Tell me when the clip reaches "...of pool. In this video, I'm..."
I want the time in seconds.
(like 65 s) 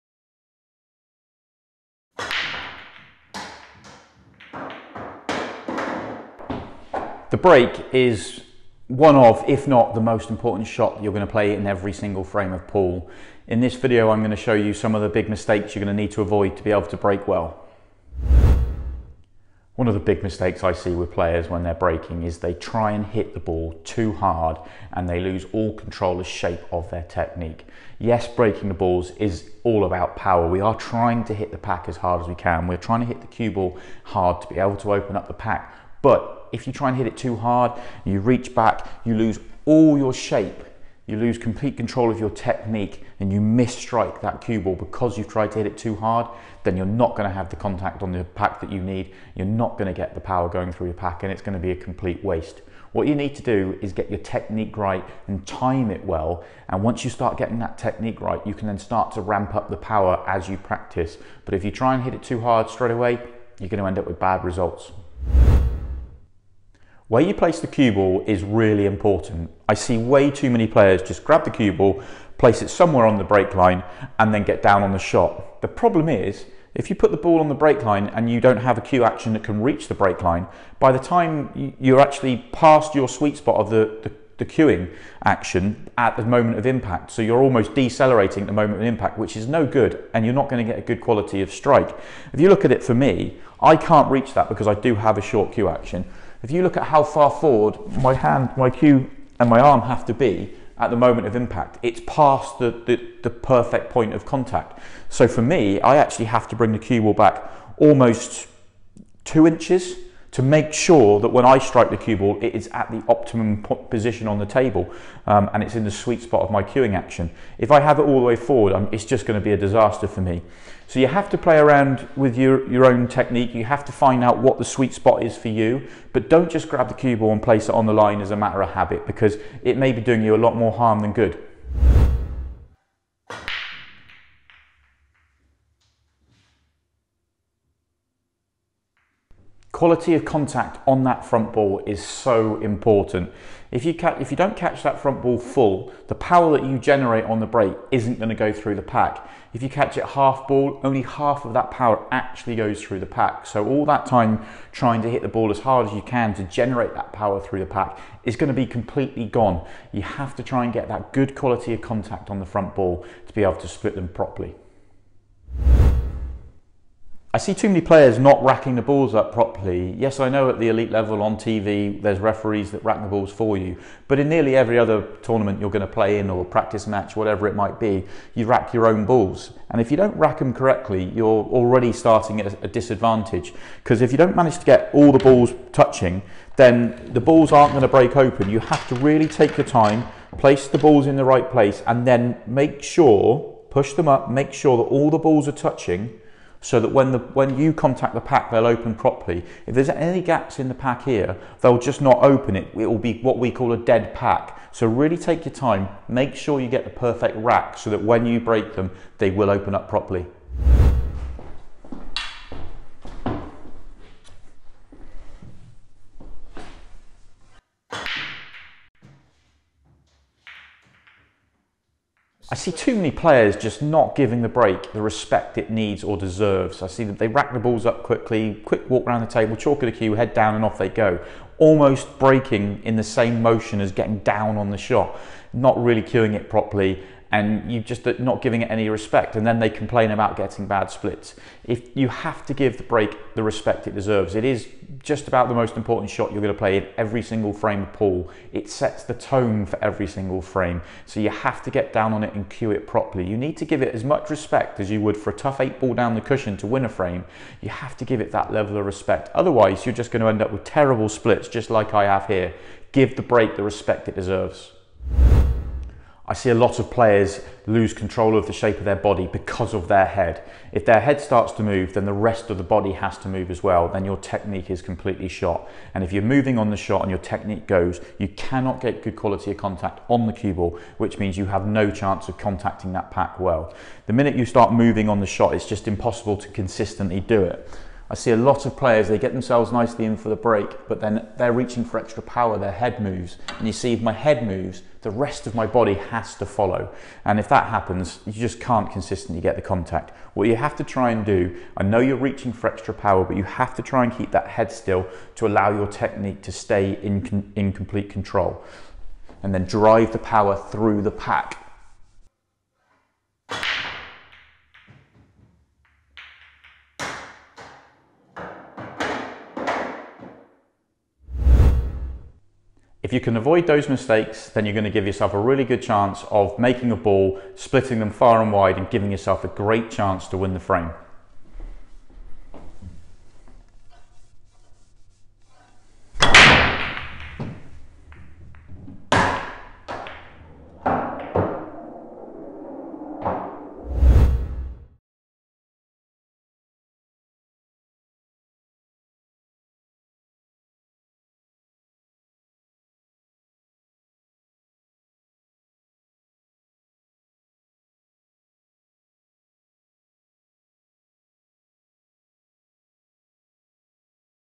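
12 s.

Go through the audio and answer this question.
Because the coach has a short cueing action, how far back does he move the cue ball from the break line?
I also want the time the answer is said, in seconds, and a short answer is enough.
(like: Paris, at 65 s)
almost 2 inches, at 107 s.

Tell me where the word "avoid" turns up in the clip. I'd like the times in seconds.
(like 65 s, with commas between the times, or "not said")
16 s, 323 s.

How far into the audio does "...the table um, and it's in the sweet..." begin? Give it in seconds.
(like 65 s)
114 s.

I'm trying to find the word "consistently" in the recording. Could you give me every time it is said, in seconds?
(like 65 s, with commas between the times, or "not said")
286 s, 298 s.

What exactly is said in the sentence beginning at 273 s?
Then your technique is completely shot.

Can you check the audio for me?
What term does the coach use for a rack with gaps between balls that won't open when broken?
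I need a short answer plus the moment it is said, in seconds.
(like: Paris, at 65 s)
dead pack, at 203 s.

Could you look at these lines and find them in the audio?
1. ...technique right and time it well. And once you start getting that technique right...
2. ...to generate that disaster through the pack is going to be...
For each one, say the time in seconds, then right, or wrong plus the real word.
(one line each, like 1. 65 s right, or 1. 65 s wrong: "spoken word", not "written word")
1. 54 s right
2. 156 s wrong: "power", not "disaster".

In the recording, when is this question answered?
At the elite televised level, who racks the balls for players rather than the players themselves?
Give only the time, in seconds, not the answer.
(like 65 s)
172 s.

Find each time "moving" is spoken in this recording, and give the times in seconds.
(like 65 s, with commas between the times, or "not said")
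276 s, 284 s.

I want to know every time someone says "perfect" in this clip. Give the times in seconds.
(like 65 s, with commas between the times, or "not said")
103 s, 206 s.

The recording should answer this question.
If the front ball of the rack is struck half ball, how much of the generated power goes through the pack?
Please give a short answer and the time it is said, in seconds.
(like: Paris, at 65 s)
only half, at 150 s.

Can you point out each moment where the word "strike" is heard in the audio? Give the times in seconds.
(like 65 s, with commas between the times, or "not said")
43 s, 91 s, 111 s.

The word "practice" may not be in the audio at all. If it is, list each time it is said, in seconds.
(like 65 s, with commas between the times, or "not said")
60 s, 176 s.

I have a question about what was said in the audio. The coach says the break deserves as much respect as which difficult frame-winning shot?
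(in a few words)
a tough eight ball down the cushion.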